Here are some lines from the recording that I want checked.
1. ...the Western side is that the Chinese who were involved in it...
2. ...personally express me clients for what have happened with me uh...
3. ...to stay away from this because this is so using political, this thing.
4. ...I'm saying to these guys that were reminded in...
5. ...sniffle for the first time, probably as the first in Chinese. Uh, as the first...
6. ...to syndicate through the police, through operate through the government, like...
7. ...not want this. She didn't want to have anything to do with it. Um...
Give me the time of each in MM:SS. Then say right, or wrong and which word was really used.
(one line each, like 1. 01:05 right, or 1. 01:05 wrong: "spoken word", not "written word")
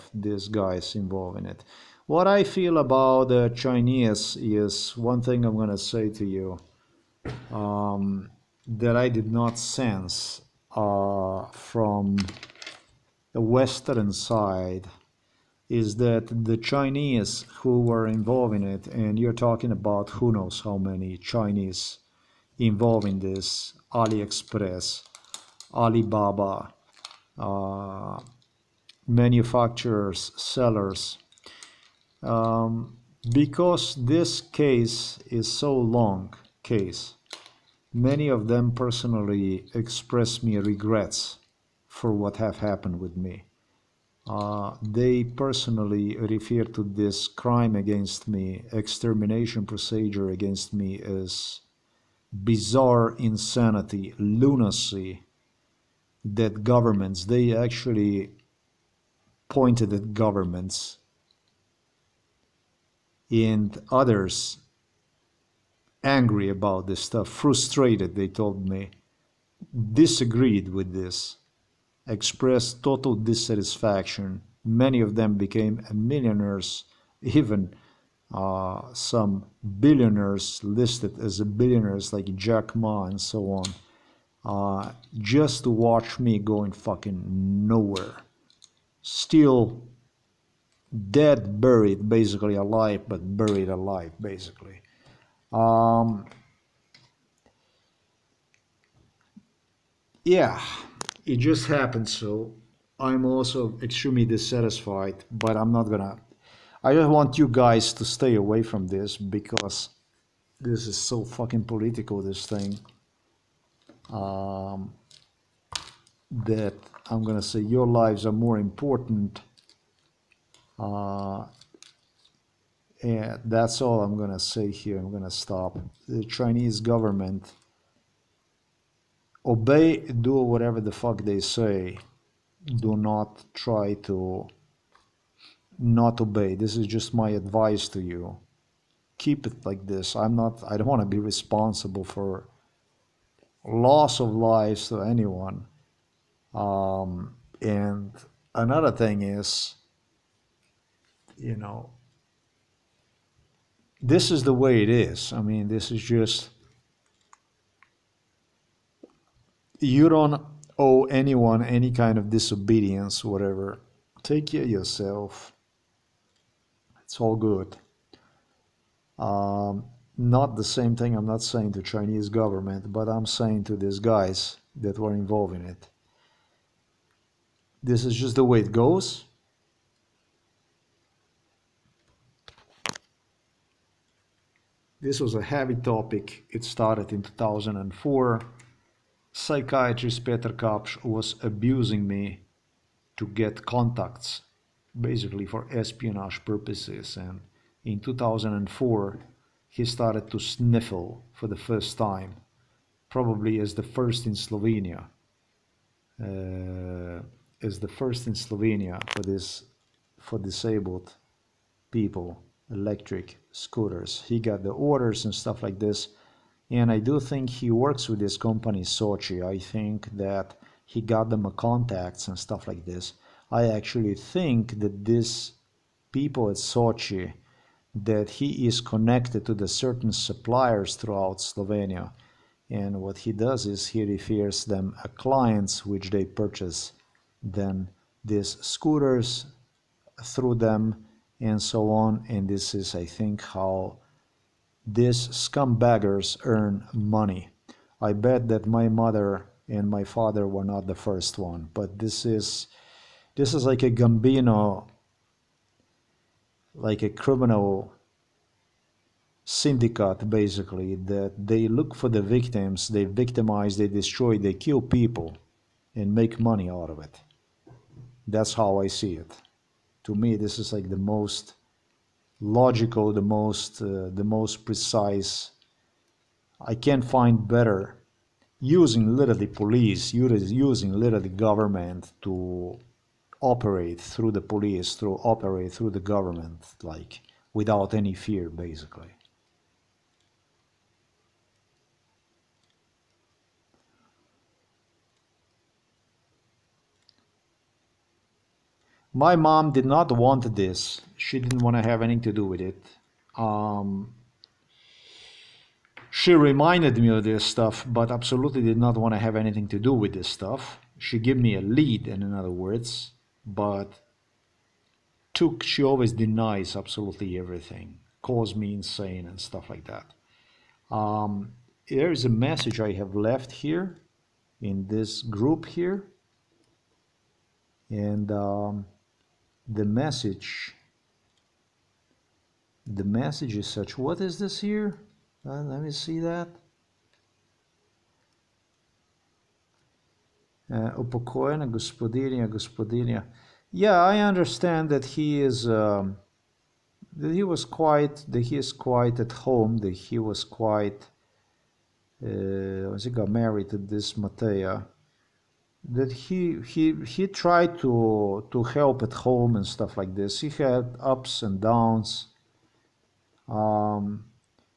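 1. 00:13 right
2. 00:38 wrong: "regrets", not "clients"
3. 01:47 wrong: "fucking", not "using"
4. 02:53 wrong: "involved", not "reminded"
5. 03:20 wrong: "Slovenia", not "Chinese"
6. 04:42 wrong: "operate", not "syndicate"
7. 04:59 right.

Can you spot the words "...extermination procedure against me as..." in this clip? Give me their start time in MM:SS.
00:48.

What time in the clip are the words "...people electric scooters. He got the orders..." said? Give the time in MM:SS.
03:31.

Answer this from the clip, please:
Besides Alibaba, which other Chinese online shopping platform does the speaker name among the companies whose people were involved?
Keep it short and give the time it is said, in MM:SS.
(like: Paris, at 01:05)
AliExpress, at 00:23.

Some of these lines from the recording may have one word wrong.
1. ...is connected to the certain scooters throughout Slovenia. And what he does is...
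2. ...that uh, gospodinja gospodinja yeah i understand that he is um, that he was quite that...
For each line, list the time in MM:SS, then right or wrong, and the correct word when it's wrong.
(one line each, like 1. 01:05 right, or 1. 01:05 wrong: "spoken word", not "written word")
1. 03:48 wrong: "suppliers", not "scooters"
2. 05:36 right.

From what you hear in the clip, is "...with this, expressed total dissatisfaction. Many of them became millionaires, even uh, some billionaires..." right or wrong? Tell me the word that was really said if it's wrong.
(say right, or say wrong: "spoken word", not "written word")
right.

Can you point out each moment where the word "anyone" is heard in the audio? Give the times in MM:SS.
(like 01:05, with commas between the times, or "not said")
02:25, 02:41.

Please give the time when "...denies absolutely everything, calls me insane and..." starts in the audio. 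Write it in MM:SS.
05:16.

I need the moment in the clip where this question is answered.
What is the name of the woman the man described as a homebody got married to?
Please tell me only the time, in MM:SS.
05:54.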